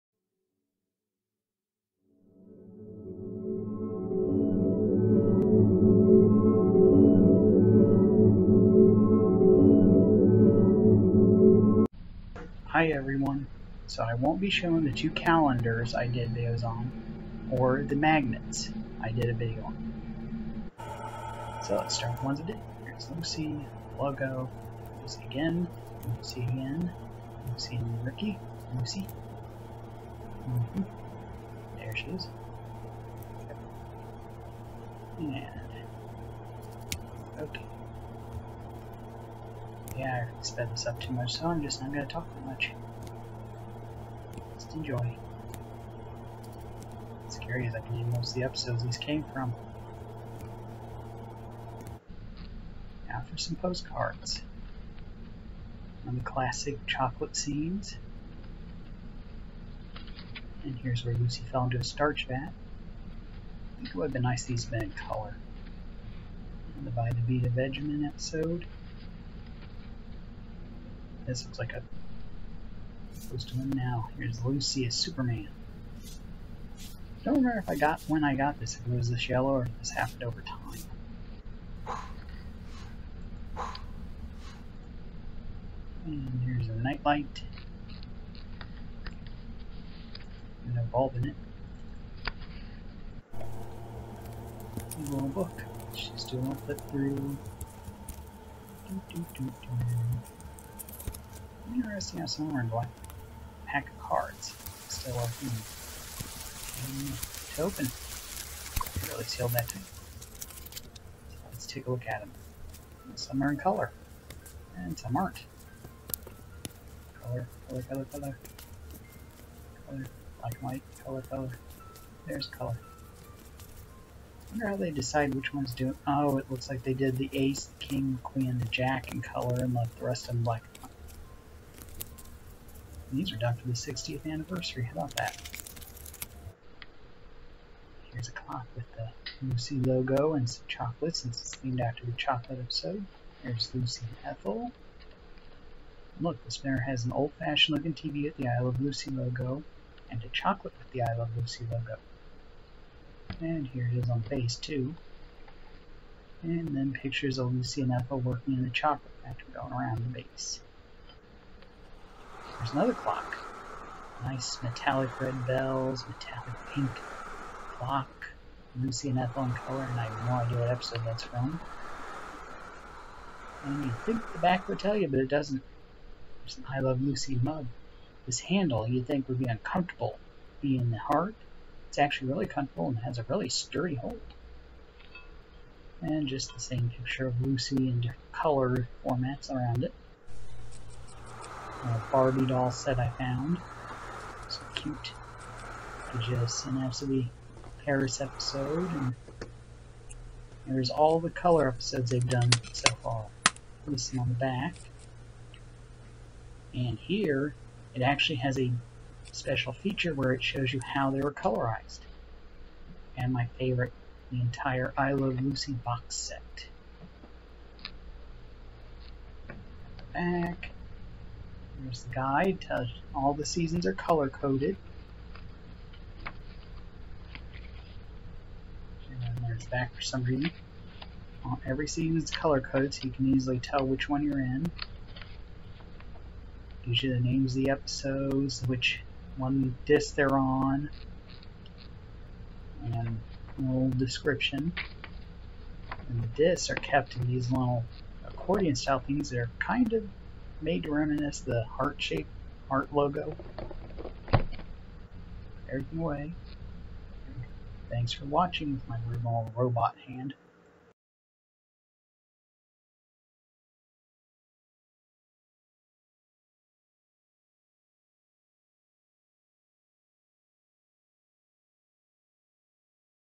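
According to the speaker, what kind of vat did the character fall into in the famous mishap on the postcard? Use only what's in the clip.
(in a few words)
Starch vat.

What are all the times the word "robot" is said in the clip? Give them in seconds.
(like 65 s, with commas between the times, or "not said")
259 s.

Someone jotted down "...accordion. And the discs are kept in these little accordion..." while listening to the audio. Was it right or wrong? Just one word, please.
wrong.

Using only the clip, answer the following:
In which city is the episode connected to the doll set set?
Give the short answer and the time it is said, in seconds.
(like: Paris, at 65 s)
Paris, at 197 s.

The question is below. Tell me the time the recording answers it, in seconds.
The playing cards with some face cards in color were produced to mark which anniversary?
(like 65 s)
133 s.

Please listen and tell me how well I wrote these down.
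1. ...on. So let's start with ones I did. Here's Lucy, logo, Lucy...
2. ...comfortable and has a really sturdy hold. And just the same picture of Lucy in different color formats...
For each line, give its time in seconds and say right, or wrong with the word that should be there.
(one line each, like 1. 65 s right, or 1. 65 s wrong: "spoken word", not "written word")
1. 19 s right
2. 182 s right.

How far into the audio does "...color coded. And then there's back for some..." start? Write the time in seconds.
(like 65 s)
223 s.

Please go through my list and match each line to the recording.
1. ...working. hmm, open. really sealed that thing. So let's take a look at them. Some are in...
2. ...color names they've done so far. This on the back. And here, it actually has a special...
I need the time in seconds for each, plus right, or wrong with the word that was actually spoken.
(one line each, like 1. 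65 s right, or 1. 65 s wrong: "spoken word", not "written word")
1. 105 s right
2. 201 s wrong: "episodes", not "names".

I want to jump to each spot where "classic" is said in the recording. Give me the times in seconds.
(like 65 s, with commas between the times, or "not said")
56 s.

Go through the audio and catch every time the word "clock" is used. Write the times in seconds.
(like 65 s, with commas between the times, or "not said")
138 s, 162 s, 167 s.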